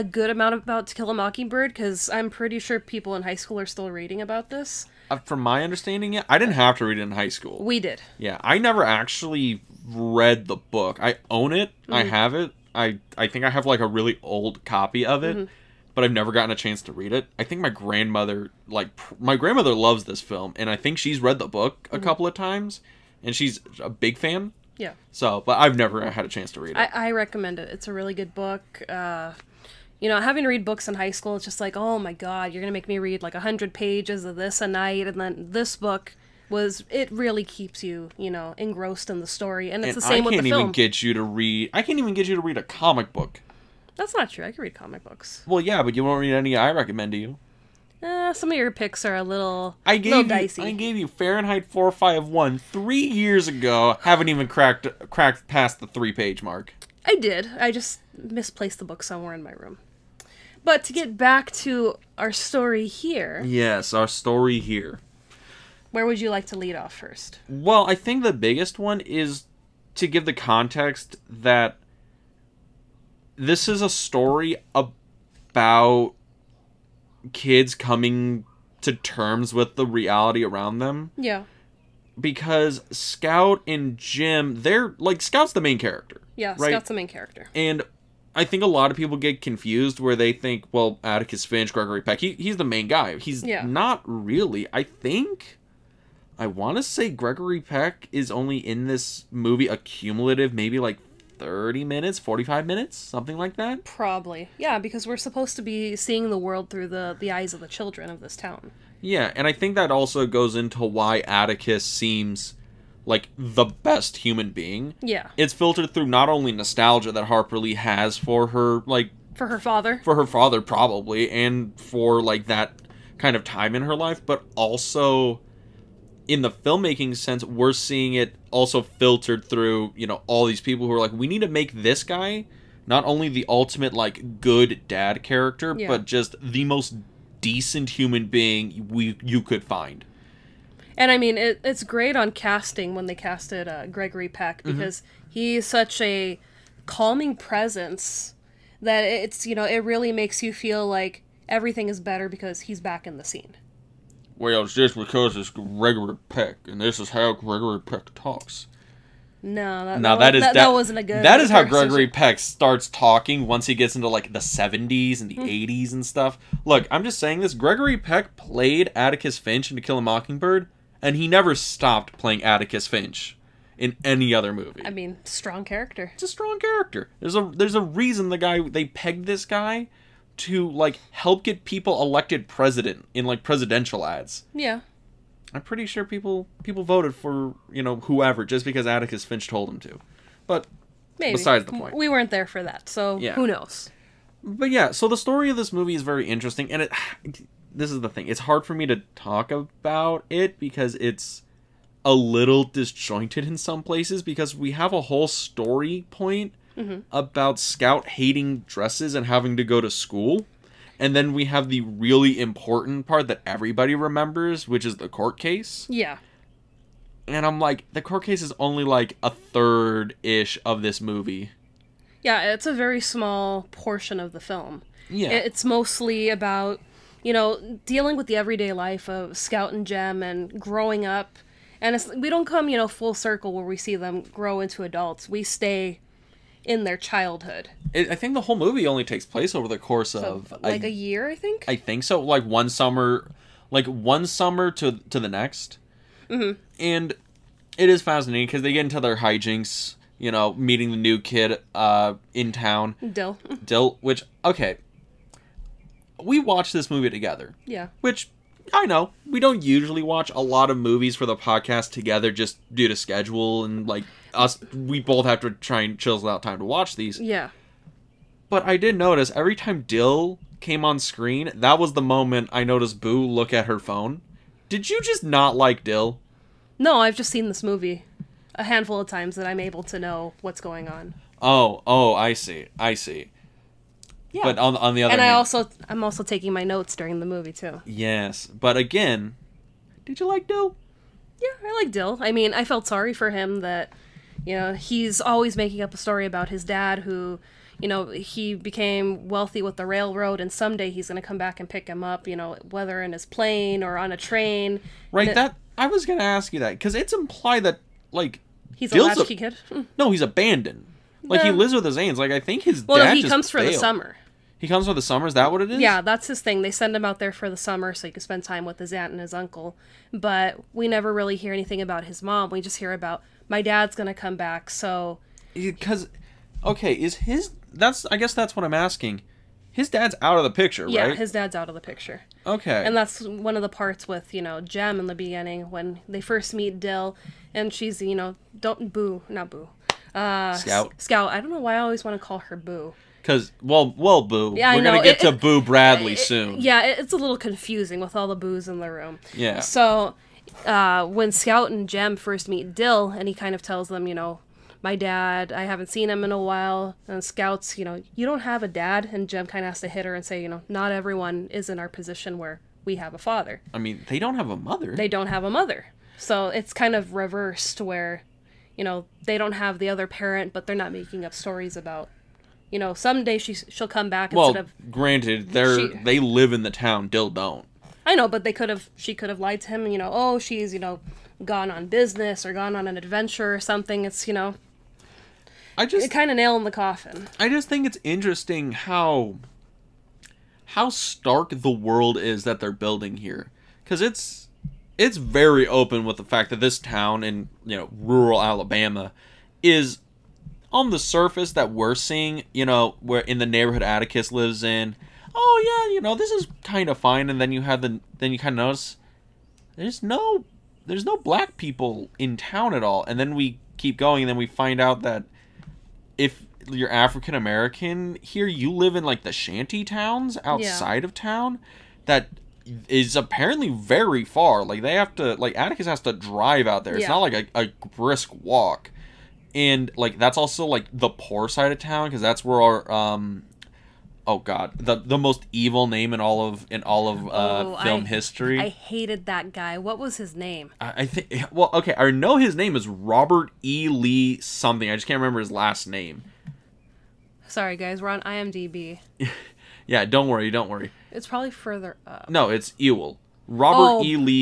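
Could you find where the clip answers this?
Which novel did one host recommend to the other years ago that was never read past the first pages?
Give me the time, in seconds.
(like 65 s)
51 s.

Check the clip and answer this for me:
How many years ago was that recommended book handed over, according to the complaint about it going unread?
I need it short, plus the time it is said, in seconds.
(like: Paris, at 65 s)
3, at 52 s.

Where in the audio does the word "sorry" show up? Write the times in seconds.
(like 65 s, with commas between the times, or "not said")
292 s, 447 s.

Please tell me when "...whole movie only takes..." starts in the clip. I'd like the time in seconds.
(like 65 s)
238 s.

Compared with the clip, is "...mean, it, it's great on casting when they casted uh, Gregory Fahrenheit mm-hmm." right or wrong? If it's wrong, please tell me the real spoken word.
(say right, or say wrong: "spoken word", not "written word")
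wrong: "Peck", not "Fahrenheit".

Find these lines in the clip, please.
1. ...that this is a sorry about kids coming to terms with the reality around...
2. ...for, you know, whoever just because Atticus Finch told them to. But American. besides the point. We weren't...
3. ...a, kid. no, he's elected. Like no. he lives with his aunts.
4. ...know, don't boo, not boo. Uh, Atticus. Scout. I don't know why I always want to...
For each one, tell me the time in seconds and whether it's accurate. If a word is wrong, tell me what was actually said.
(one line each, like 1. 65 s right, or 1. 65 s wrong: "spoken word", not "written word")
1. 71 s wrong: "story", not "sorry"
2. 187 s wrong: "Maybe", not "American"
3. 309 s wrong: "abandoned", not "elected"
4. 338 s wrong: "Scout", not "Atticus".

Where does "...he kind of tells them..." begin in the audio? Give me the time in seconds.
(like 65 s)
353 s.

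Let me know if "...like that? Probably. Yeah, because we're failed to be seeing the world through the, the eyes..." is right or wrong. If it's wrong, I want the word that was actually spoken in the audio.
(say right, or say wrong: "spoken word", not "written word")
wrong: "supposed", not "failed".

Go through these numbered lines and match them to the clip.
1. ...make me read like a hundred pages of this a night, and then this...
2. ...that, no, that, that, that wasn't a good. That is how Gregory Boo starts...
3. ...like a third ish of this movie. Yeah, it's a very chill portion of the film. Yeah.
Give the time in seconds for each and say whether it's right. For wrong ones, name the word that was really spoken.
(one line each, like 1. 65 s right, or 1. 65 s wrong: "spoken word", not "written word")
1. 32 s right
2. 159 s wrong: "Peck", not "Boo"
3. 218 s wrong: "small", not "chill".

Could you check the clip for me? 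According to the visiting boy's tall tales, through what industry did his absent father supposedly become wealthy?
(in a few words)
the railroad.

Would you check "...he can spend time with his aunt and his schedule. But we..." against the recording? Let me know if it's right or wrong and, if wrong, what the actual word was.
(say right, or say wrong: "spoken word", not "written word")
wrong: "uncle", not "schedule".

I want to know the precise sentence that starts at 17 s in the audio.
I think my grandmother like my grandmother loves this film and I think she's read the book a mm-hmm.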